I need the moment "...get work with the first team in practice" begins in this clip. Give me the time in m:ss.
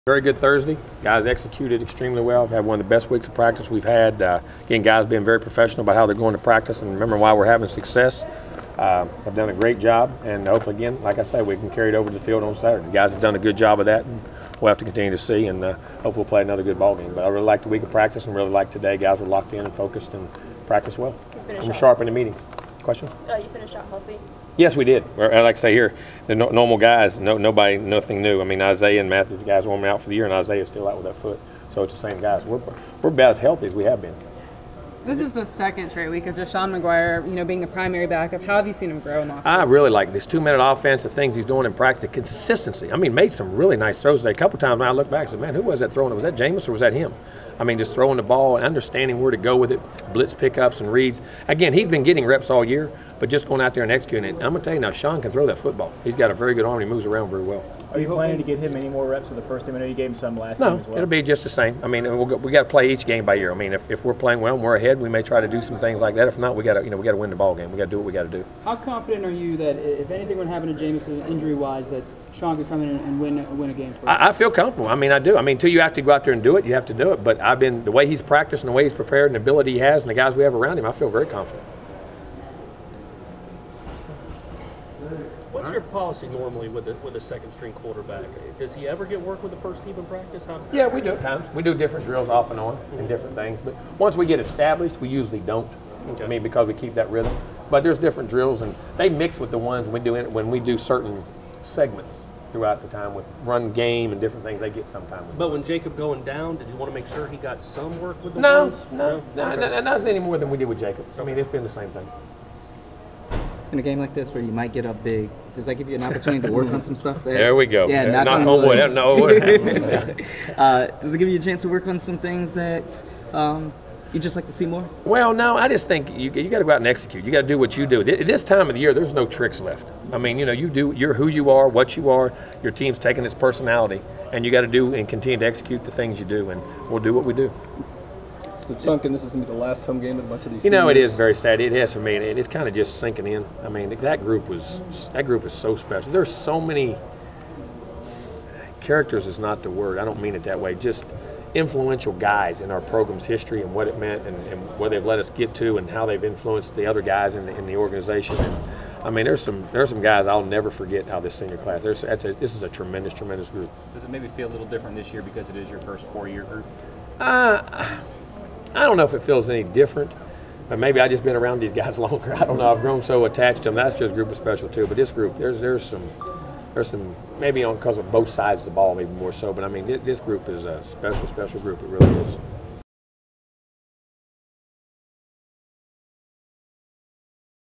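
1:29.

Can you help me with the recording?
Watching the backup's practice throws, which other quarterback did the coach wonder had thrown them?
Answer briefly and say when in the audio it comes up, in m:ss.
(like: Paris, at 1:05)
Jameis, at 0:46.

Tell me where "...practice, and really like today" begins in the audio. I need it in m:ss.
0:17.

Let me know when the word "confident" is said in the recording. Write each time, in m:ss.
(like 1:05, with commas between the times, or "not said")
1:08, 1:21.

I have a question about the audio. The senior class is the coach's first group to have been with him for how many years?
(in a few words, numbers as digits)
4.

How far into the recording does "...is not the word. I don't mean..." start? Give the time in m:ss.
2:29.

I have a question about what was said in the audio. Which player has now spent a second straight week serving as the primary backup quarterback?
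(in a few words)
Deshaun Maguire.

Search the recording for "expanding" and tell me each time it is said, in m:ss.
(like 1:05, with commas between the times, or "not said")
not said.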